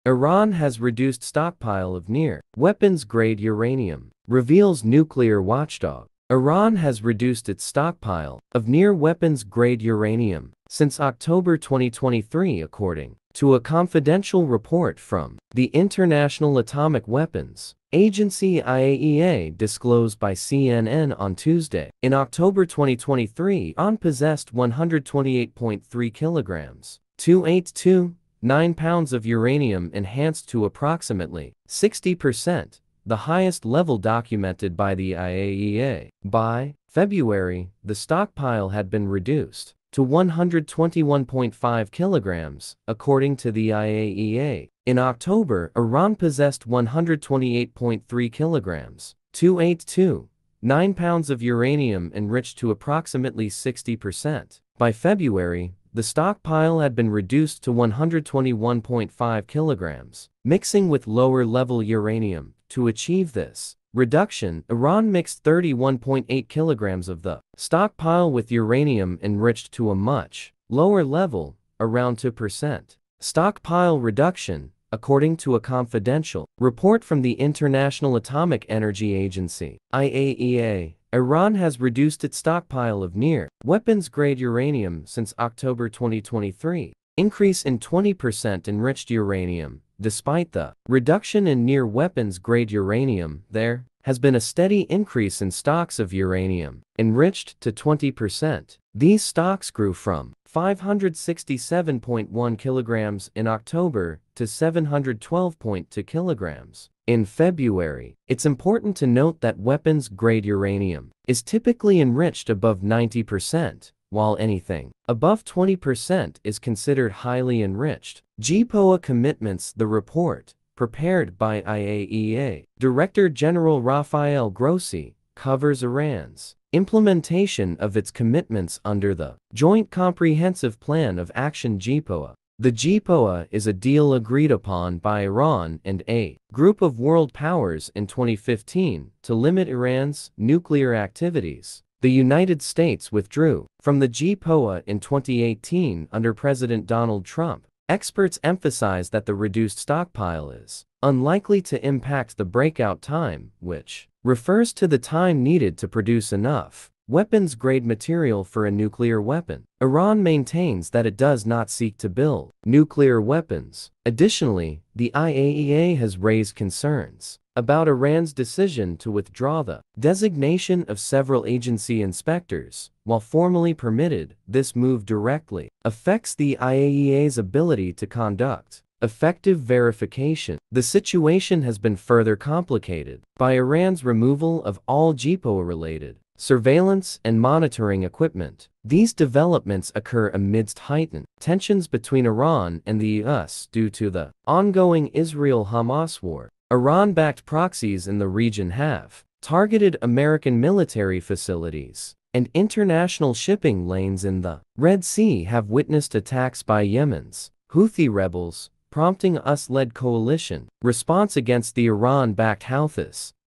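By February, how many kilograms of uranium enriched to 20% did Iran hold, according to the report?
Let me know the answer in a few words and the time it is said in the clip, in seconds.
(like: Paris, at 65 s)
712.2 kilograms, at 104 s.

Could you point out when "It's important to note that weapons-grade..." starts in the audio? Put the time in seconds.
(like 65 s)
108 s.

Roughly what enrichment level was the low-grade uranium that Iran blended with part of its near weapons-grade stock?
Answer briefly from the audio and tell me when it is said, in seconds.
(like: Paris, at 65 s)
2%, at 71 s.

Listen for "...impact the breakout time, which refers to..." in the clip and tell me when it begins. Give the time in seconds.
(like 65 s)
151 s.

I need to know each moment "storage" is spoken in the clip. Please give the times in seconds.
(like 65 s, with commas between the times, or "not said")
not said.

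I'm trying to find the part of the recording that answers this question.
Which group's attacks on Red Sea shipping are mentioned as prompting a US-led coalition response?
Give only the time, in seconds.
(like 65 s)
207 s.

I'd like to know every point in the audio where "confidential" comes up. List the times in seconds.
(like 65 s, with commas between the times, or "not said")
13 s, 75 s.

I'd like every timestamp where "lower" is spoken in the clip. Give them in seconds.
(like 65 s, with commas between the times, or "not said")
61 s, 70 s.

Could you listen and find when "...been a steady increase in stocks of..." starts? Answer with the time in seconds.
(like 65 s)
94 s.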